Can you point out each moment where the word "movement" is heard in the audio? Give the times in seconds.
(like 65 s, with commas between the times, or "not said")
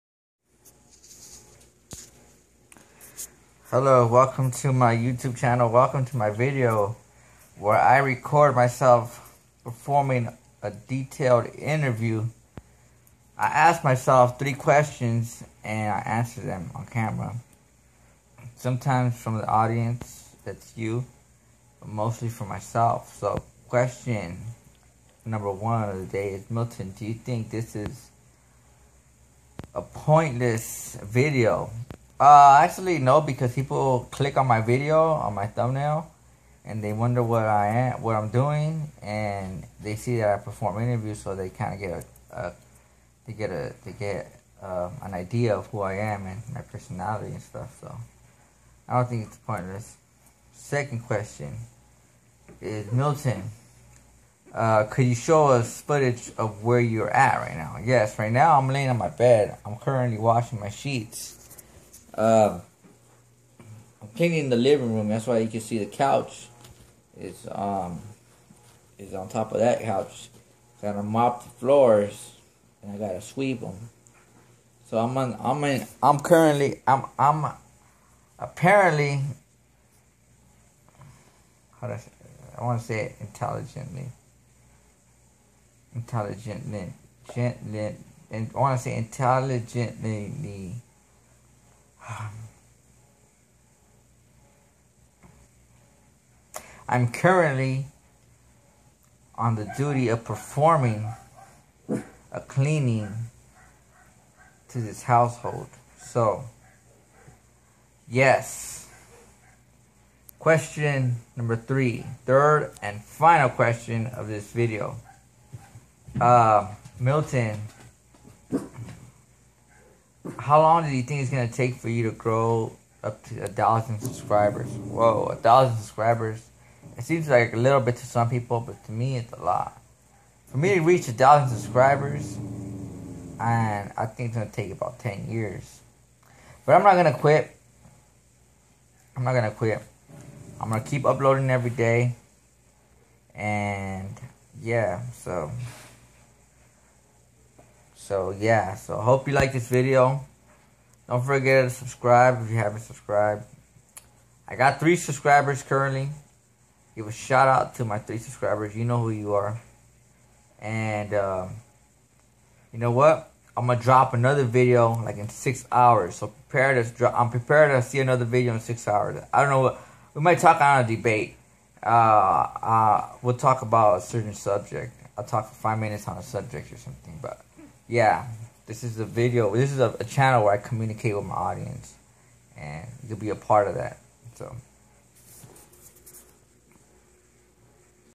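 not said.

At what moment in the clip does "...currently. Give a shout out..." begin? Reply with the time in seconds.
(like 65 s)
155 s.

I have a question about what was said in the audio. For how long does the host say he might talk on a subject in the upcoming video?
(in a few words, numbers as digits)
5 minutes.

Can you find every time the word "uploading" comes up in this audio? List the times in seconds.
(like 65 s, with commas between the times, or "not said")
141 s.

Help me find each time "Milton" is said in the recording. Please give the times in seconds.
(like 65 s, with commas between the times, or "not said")
26 s, 52 s, 116 s.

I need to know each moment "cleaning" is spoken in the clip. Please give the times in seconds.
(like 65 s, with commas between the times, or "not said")
64 s, 102 s.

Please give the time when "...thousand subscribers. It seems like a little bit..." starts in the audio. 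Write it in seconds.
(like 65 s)
125 s.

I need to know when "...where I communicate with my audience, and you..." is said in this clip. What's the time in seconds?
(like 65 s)
180 s.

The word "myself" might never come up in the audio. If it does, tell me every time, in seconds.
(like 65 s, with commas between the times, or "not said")
8 s, 13 s, 22 s.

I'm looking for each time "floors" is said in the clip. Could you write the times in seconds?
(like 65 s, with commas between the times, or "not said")
71 s.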